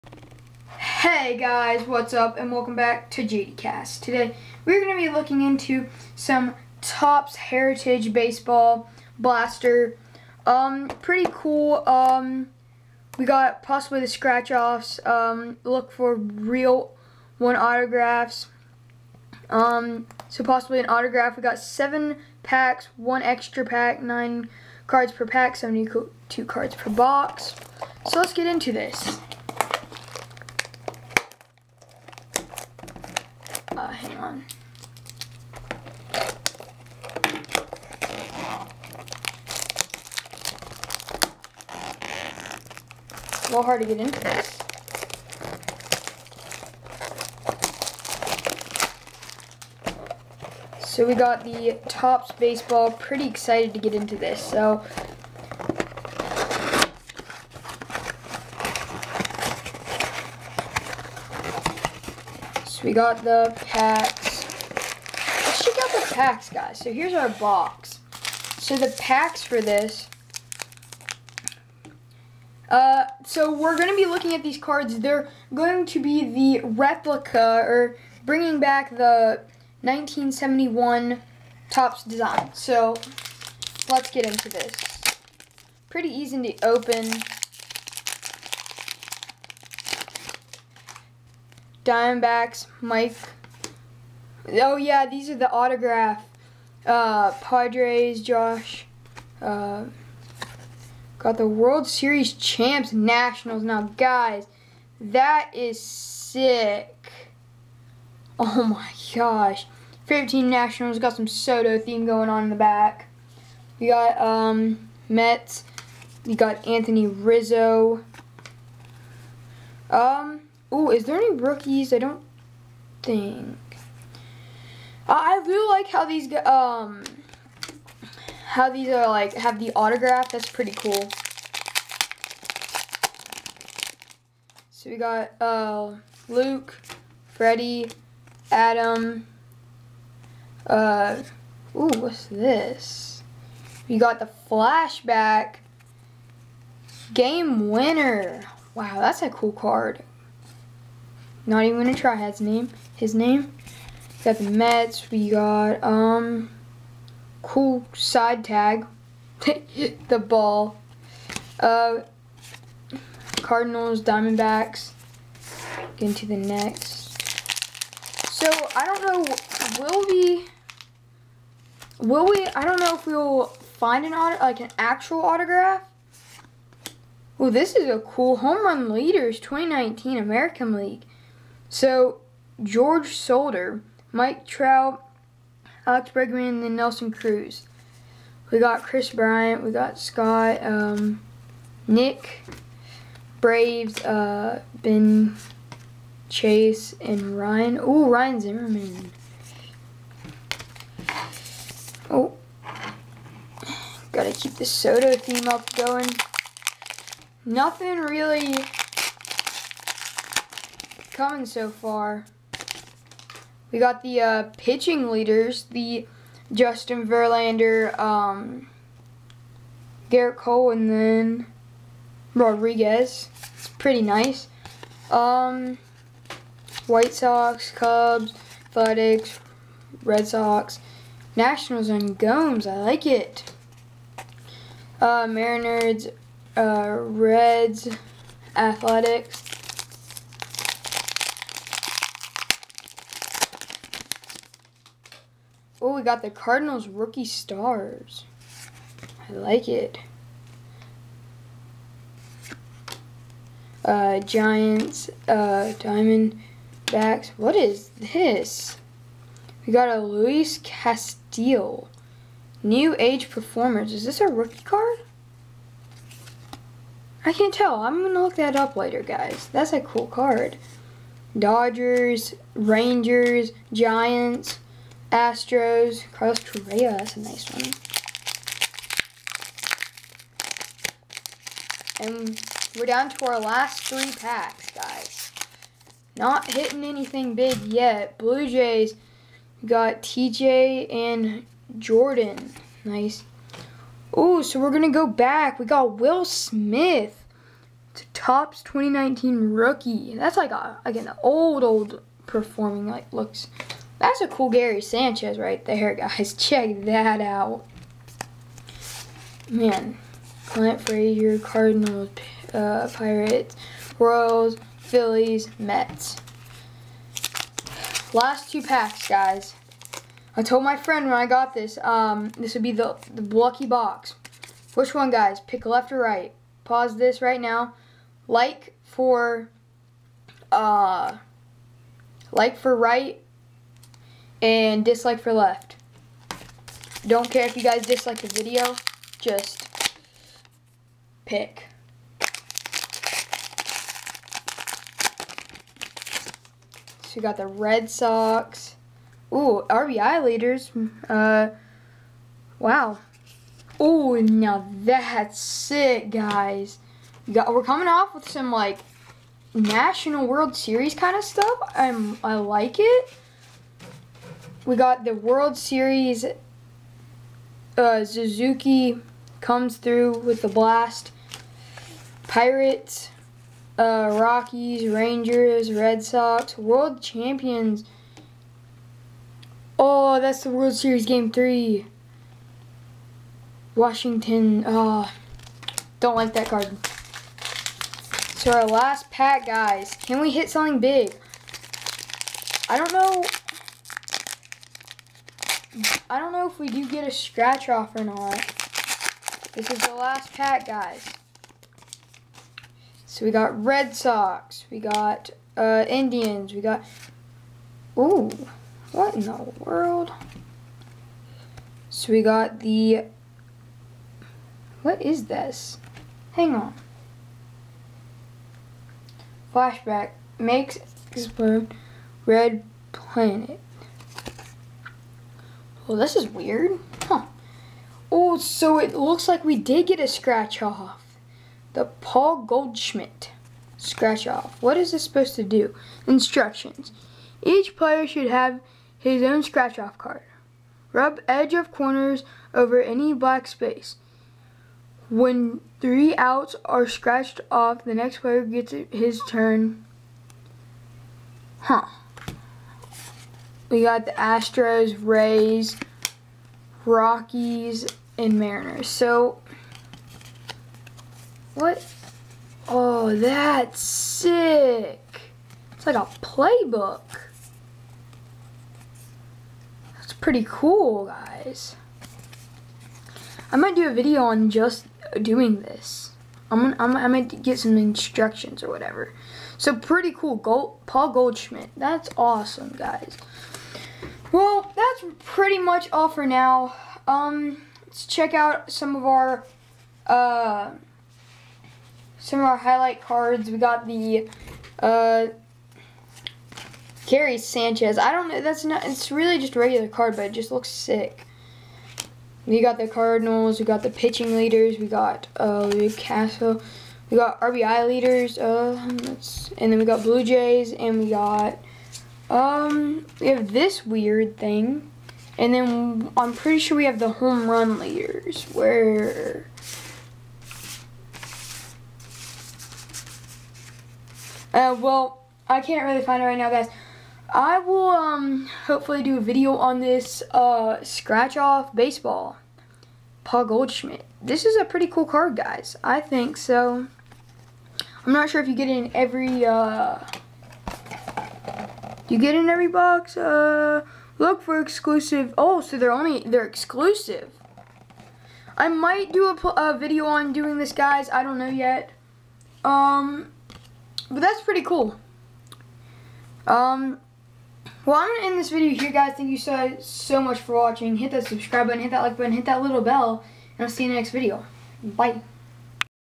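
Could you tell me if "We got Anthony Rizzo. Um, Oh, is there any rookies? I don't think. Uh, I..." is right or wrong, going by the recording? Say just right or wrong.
right.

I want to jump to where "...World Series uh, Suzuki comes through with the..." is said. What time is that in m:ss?
6:05.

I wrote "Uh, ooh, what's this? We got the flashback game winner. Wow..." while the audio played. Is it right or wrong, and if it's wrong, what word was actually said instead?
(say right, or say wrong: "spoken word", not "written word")
right.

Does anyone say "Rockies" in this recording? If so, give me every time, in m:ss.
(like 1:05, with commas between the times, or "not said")
6:14, 7:36.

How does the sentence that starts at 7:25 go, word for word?
When three outs are scratched off, the next player gets his turn.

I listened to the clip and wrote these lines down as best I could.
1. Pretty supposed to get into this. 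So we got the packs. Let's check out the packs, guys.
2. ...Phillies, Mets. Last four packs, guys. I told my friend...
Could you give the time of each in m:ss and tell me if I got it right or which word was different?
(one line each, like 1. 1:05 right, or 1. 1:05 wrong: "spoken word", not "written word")
1. 0:52 wrong: "excited", not "supposed"
2. 5:14 wrong: "two", not "four".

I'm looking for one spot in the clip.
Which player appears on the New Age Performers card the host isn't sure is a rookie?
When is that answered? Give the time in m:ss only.
4:19.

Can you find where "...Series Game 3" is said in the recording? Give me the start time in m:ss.
6:20.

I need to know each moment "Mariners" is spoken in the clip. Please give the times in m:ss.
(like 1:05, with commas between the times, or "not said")
3:55, 7:38.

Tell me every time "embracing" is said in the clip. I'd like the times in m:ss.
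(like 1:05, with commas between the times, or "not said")
not said.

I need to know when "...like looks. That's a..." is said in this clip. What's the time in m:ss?
5:02.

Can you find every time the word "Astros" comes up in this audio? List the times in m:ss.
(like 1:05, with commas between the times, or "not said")
4:35, 7:34.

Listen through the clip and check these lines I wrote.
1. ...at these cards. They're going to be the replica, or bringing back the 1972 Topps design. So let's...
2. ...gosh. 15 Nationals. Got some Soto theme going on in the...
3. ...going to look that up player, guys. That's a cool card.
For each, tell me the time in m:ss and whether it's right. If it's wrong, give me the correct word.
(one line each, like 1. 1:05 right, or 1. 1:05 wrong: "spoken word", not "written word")
1. 1:14 wrong: "1971", not "1972"
2. 1:49 right
3. 4:28 wrong: "later", not "player".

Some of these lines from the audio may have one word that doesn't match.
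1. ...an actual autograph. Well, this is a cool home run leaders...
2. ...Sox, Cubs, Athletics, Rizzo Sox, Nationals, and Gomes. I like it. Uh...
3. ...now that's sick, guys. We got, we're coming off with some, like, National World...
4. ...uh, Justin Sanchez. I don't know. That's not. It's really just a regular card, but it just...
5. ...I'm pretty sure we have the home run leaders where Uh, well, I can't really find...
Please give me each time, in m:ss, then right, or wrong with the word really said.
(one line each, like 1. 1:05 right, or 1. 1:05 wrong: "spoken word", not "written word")
1. 2:54 right
2. 3:47 wrong: "Red", not "Rizzo"
3. 5:54 right
4. 8:14 wrong: "Gary", not "Justin"
5. 8:36 right.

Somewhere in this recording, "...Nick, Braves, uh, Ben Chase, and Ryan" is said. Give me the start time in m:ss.
3:11.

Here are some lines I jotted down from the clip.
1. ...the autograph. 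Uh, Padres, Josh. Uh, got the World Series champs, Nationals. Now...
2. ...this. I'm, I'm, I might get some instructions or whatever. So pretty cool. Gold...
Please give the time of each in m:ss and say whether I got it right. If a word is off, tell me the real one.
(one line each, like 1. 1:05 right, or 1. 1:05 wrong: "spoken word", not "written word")
1. 1:35 right
2. 7:55 right.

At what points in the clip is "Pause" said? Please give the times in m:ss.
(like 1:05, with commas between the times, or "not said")
5:26.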